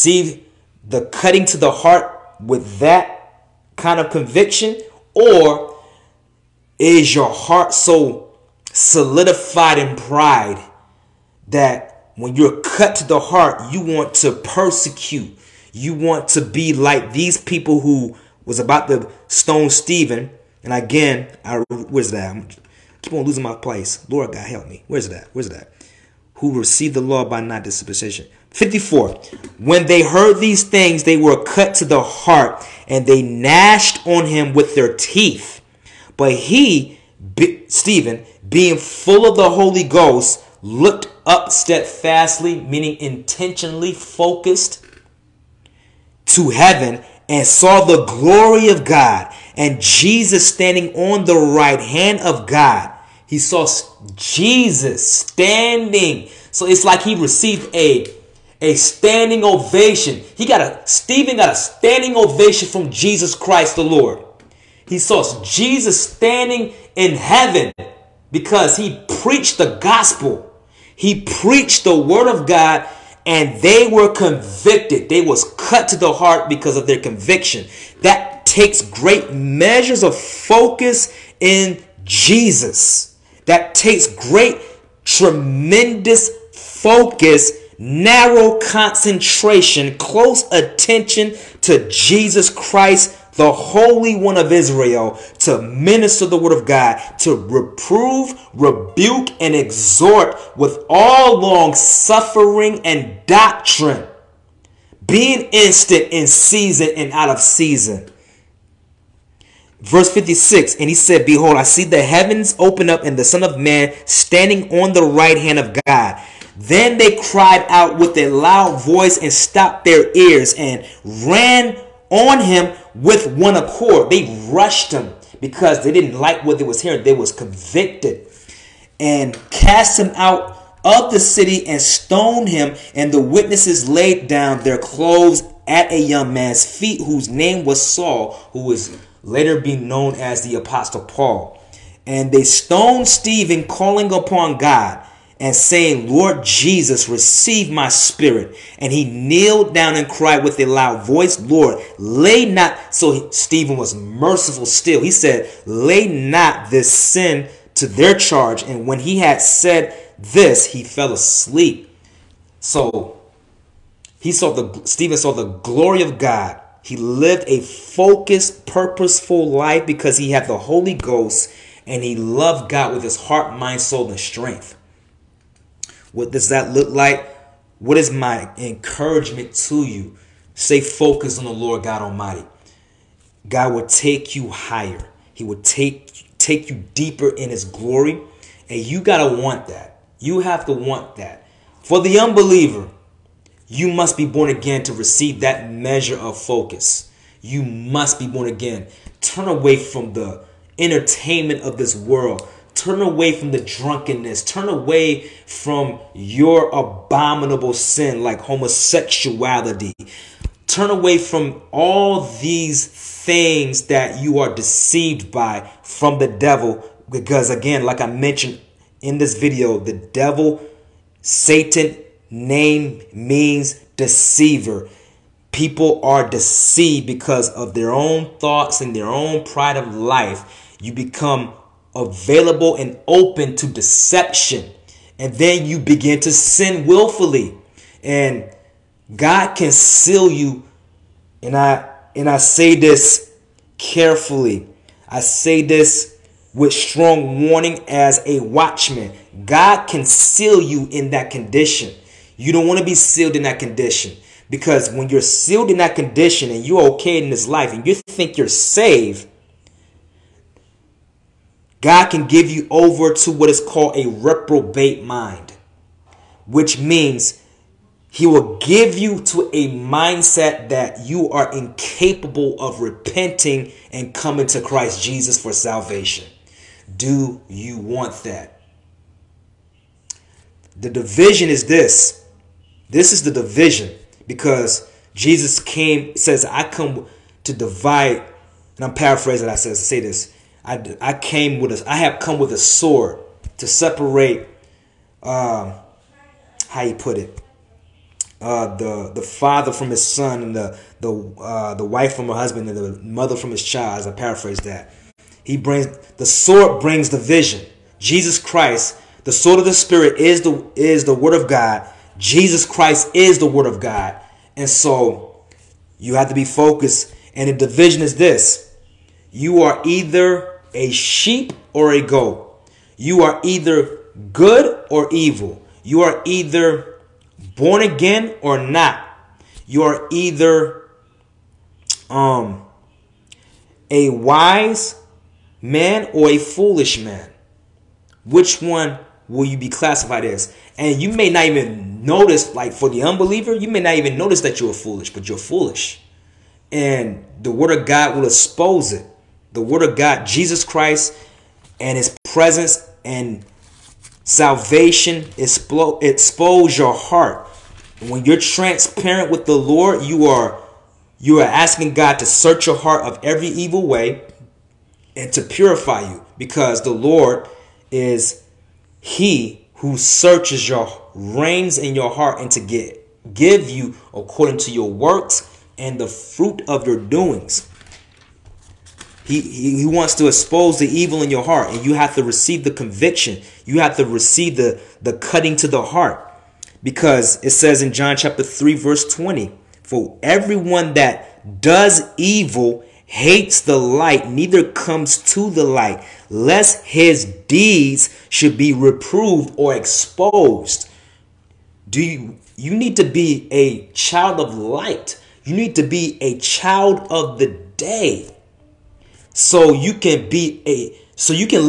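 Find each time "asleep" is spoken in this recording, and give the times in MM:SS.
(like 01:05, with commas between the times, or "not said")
02:41.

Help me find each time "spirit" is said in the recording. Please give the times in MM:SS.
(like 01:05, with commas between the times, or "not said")
02:27, 05:09.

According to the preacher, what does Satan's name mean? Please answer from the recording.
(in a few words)
deceiver.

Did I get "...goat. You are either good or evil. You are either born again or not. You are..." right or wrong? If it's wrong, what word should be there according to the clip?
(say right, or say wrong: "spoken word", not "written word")
right.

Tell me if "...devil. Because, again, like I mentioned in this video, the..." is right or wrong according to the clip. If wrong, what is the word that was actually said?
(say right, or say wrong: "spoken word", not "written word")
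right.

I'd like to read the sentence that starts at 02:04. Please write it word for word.
They rushed him because they didn't like what they was hearing.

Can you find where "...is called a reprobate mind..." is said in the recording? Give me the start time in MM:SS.
04:23.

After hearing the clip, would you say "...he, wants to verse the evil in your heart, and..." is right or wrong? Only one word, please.
wrong.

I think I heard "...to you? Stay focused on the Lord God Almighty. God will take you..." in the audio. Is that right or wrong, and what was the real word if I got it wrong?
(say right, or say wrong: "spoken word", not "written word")
right.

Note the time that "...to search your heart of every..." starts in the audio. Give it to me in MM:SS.
06:02.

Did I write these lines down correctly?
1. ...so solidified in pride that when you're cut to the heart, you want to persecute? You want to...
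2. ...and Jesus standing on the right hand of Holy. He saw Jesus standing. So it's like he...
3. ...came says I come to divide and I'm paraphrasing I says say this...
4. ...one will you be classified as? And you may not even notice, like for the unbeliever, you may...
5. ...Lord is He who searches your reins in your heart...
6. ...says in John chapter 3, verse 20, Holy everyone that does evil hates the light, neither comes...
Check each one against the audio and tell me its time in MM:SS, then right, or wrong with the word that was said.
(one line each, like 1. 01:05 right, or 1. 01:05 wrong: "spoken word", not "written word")
1. 00:07 right
2. 00:49 wrong: "God", not "Holy"
3. 04:45 right
4. 05:38 right
5. 06:06 right
6. 06:27 wrong: "For", not "Holy".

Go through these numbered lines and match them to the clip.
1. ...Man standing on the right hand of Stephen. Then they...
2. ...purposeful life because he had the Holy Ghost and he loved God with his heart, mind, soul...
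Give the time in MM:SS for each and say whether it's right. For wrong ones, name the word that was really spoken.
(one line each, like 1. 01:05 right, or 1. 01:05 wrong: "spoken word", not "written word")
1. 01:53 wrong: "God", not "Stephen"
2. 02:48 right.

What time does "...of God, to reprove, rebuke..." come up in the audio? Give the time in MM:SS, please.
01:36.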